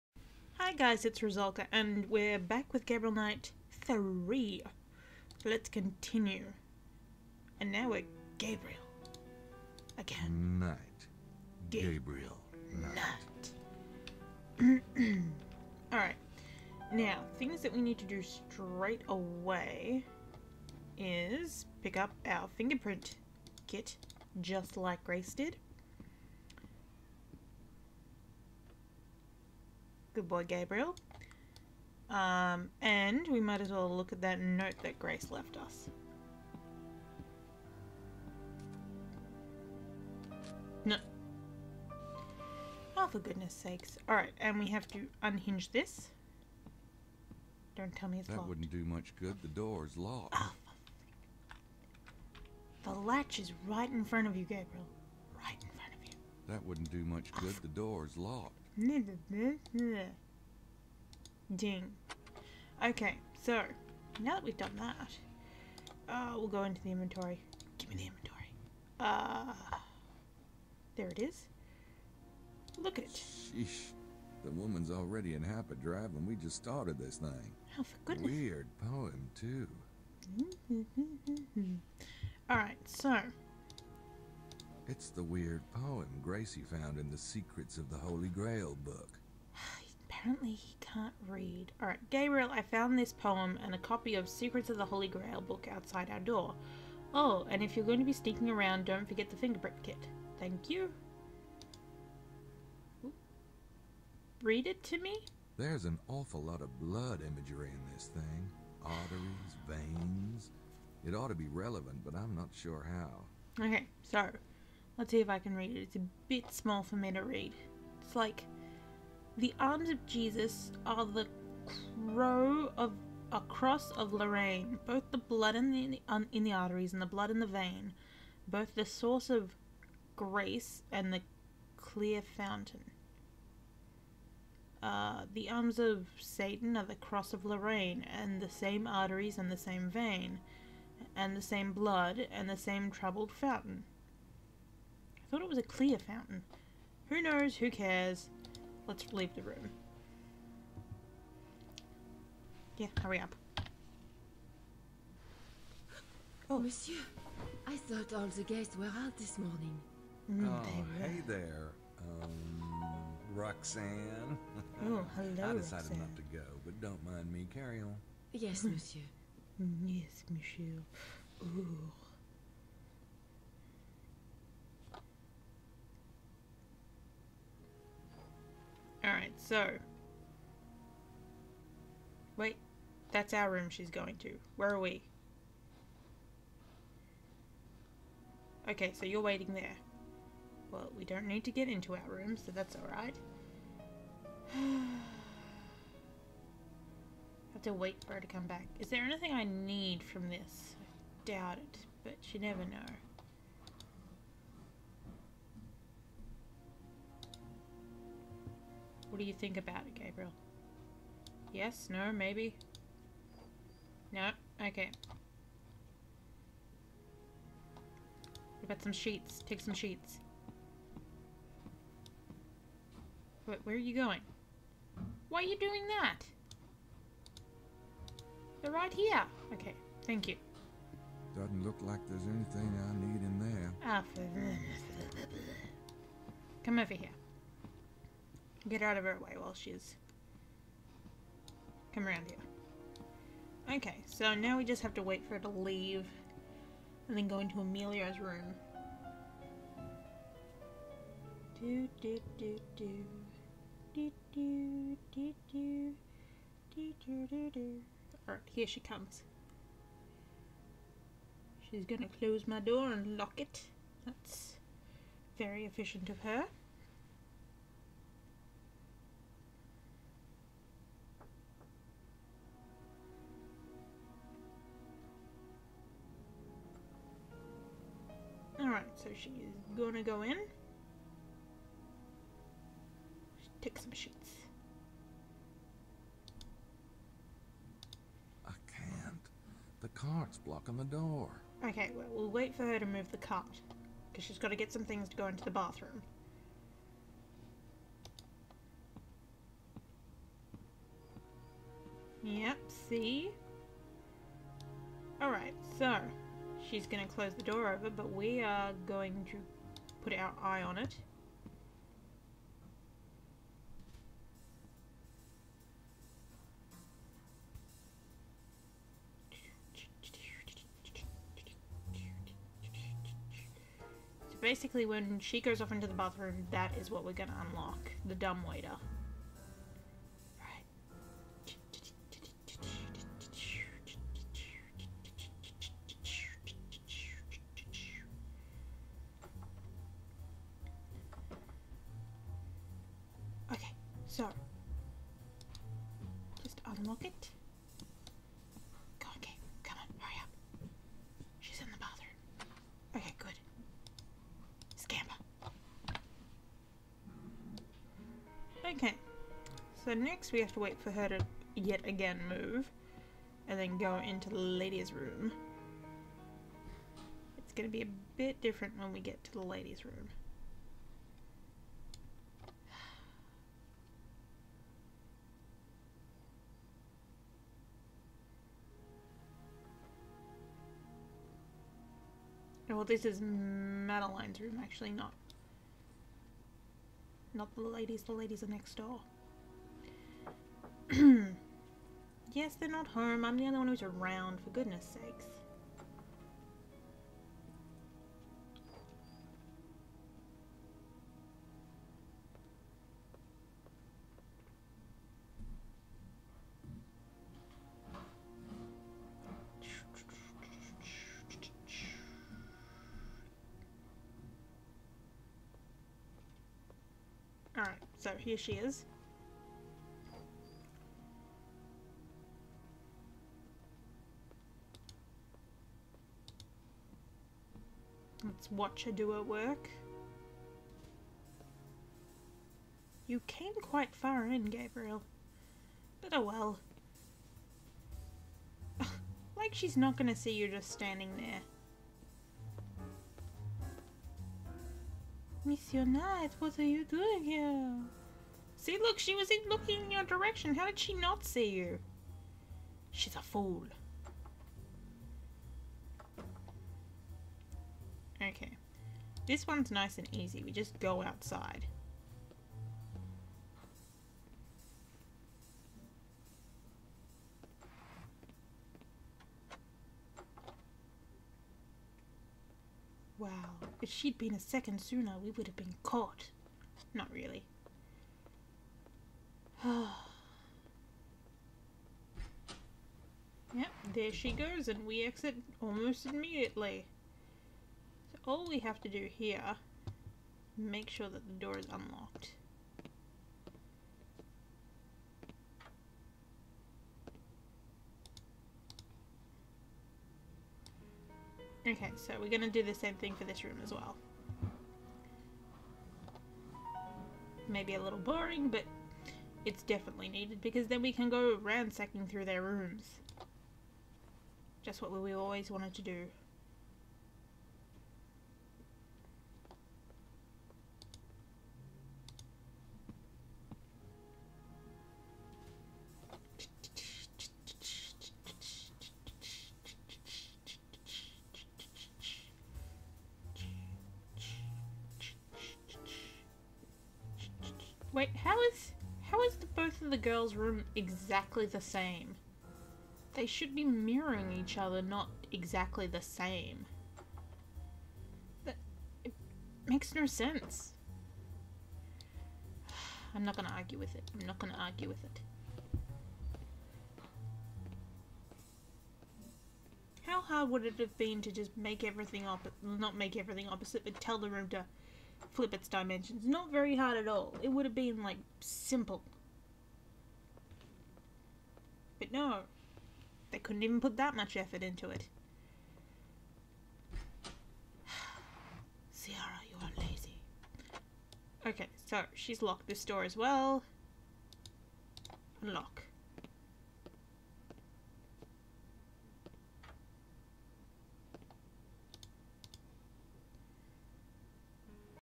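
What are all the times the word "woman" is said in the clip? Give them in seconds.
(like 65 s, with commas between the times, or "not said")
74 s.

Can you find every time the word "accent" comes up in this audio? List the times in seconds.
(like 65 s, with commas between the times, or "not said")
not said.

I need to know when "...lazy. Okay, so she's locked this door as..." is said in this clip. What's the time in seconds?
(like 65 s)
579 s.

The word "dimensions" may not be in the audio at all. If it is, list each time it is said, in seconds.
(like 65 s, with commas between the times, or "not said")
565 s.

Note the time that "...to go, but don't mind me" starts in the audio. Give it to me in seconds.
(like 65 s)
166 s.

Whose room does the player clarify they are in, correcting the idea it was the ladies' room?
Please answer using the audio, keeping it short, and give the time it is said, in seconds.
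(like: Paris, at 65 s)
Madeline's, at 383 s.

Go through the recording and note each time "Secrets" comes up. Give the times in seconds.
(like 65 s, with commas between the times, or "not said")
87 s, 94 s.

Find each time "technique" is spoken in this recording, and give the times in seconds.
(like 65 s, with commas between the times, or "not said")
not said.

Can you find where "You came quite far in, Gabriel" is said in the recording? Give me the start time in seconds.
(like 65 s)
433 s.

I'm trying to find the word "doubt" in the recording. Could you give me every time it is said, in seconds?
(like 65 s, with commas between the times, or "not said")
201 s.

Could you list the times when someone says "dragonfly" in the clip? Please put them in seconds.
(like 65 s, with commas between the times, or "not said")
not said.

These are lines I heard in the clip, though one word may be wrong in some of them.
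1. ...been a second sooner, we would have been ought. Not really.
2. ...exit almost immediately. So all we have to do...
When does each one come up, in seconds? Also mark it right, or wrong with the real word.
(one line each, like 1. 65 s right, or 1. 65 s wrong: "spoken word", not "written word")
1. 474 s wrong: "caught", not "ought"
2. 485 s right.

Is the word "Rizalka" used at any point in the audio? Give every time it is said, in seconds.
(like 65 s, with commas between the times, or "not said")
1 s.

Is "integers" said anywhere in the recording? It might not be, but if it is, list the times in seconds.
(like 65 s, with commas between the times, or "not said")
not said.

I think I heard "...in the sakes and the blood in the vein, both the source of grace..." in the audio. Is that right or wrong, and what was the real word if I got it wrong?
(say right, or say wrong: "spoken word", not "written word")
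wrong: "arteries", not "sakes".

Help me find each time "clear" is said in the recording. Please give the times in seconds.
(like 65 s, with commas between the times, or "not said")
131 s, 145 s.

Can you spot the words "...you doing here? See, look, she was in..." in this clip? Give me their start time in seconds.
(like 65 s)
446 s.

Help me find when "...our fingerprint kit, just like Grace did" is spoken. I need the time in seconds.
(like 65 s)
22 s.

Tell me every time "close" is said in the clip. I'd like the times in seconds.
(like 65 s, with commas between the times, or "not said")
262 s, 307 s.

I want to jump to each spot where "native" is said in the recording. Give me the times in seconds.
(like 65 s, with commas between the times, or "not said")
not said.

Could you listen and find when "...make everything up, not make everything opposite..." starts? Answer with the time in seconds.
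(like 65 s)
561 s.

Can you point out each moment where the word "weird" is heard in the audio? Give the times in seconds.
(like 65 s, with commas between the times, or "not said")
78 s, 85 s.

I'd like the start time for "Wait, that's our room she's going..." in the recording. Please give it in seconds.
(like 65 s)
182 s.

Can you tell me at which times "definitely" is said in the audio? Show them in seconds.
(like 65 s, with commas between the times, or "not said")
509 s.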